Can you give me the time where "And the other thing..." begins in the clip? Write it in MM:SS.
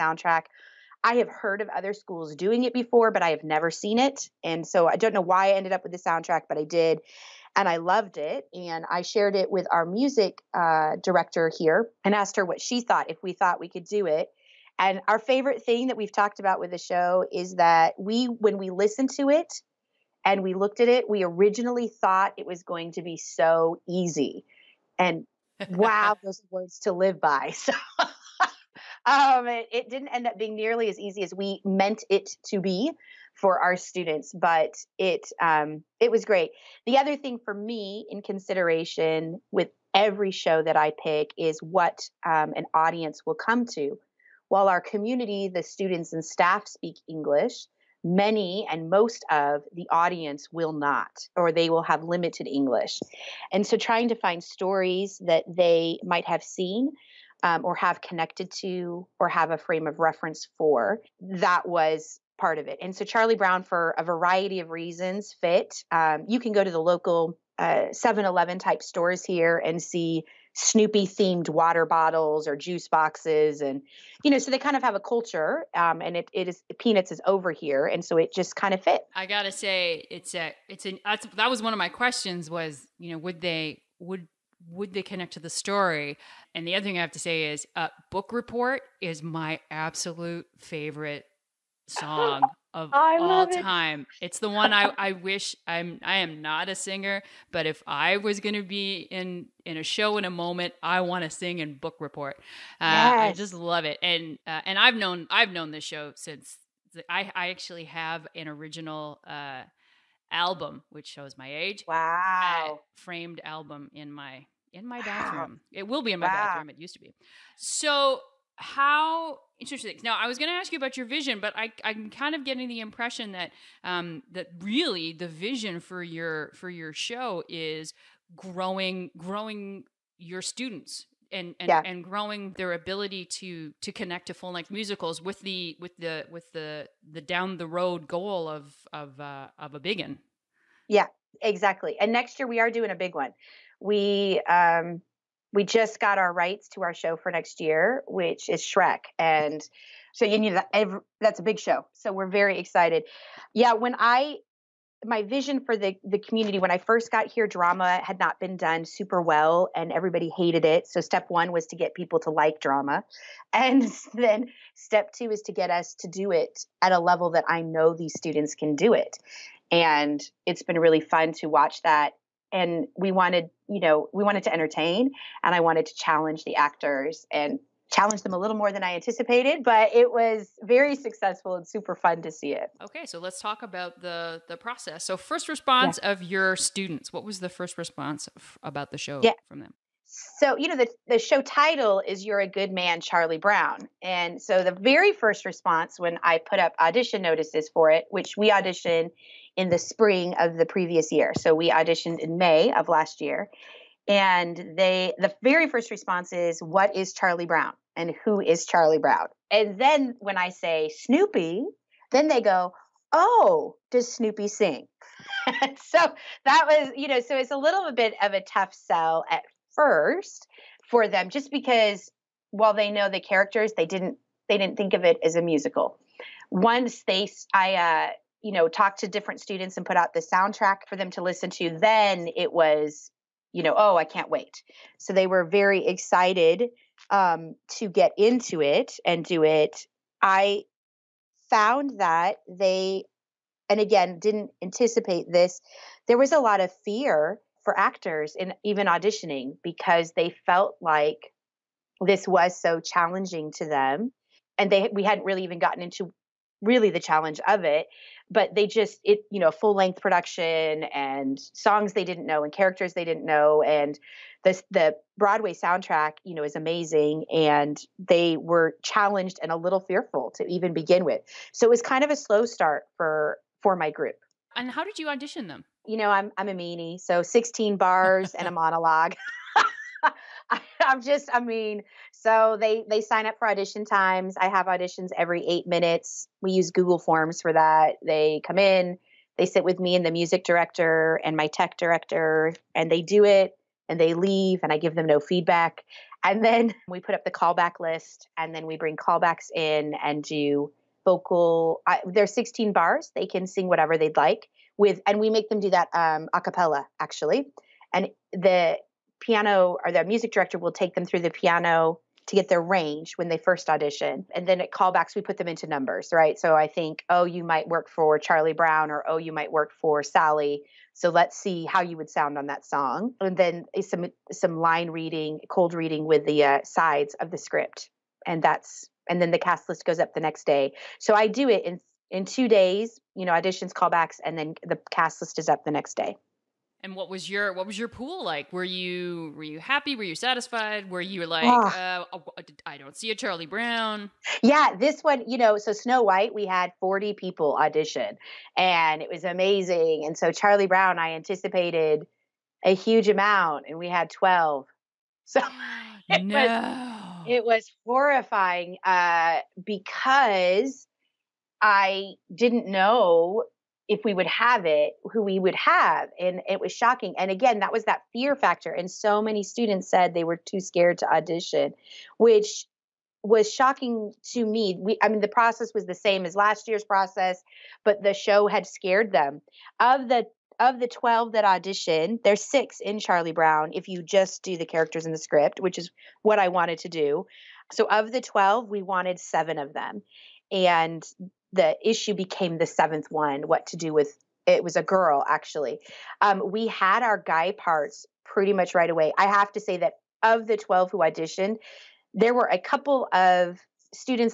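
01:26.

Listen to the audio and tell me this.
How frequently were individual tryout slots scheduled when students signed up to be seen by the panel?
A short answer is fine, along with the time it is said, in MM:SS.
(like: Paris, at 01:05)
Every 8 minutes, at 04:45.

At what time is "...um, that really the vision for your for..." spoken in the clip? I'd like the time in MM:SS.
02:03.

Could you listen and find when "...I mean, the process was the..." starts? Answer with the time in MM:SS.
06:15.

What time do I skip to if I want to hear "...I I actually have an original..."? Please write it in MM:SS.
01:47.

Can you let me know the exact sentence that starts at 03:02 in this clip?
Okay, so let's talk about the the process.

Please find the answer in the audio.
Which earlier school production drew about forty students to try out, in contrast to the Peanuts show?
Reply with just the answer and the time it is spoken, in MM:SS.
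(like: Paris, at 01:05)
Snow White, at 05:45.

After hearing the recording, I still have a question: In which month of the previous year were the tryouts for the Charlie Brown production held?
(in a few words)
May.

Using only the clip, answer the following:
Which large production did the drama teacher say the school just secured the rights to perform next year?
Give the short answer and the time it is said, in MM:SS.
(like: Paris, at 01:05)
Shrek, at 02:28.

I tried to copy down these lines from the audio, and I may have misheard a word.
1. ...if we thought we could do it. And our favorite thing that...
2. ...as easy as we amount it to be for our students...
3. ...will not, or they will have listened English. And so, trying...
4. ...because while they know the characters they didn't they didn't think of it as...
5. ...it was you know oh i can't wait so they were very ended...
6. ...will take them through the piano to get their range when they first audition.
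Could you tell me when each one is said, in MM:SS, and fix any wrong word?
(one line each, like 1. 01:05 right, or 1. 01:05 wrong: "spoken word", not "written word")
1. 00:13 right
2. 00:30 wrong: "meant", not "amount"
3. 00:50 wrong: "limited", not "listened"
4. 03:41 right
5. 03:52 wrong: "excited", not "ended"
6. 05:10 right.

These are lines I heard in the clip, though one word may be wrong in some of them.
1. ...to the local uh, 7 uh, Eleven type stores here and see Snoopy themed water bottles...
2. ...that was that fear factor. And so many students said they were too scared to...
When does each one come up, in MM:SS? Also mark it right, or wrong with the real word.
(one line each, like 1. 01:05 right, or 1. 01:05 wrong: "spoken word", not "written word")
1. 01:06 right
2. 06:07 right.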